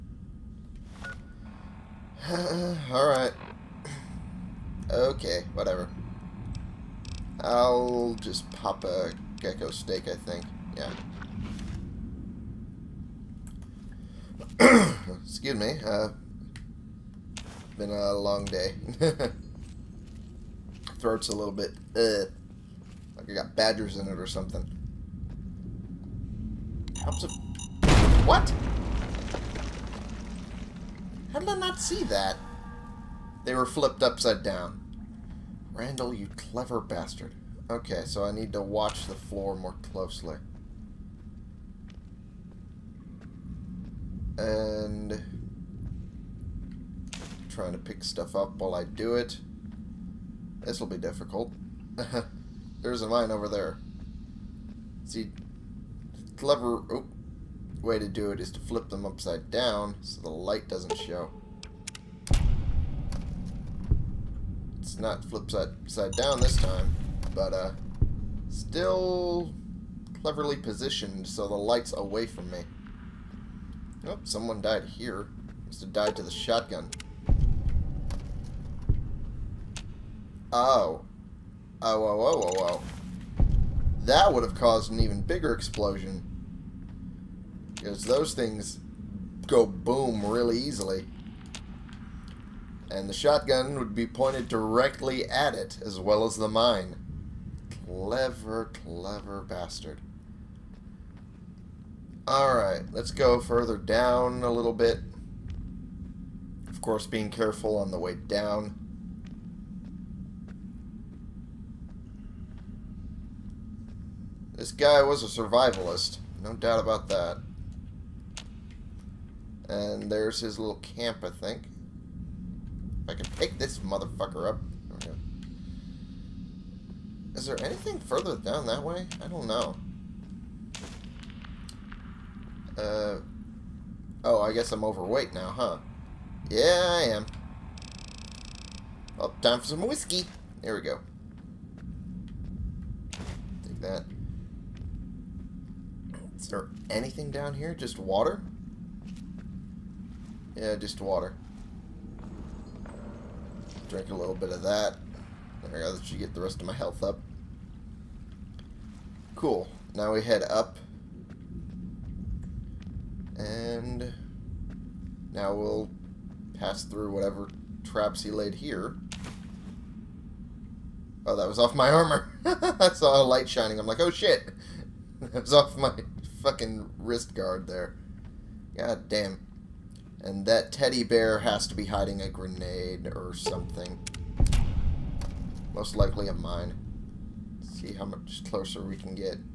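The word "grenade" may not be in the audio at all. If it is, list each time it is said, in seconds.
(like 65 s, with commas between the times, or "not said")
182 s.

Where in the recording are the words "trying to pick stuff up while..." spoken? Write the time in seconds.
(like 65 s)
47 s.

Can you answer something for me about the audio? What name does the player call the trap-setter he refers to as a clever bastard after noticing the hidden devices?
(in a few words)
Randall.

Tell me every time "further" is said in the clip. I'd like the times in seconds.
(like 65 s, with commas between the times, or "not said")
103 s, 128 s.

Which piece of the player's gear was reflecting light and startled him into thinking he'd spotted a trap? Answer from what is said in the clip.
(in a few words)
wrist guard.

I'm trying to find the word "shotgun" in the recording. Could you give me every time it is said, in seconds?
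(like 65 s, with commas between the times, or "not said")
76 s, 93 s.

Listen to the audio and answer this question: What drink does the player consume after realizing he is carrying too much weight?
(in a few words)
whiskey.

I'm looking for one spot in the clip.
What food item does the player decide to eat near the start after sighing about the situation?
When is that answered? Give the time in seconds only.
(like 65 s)
9 s.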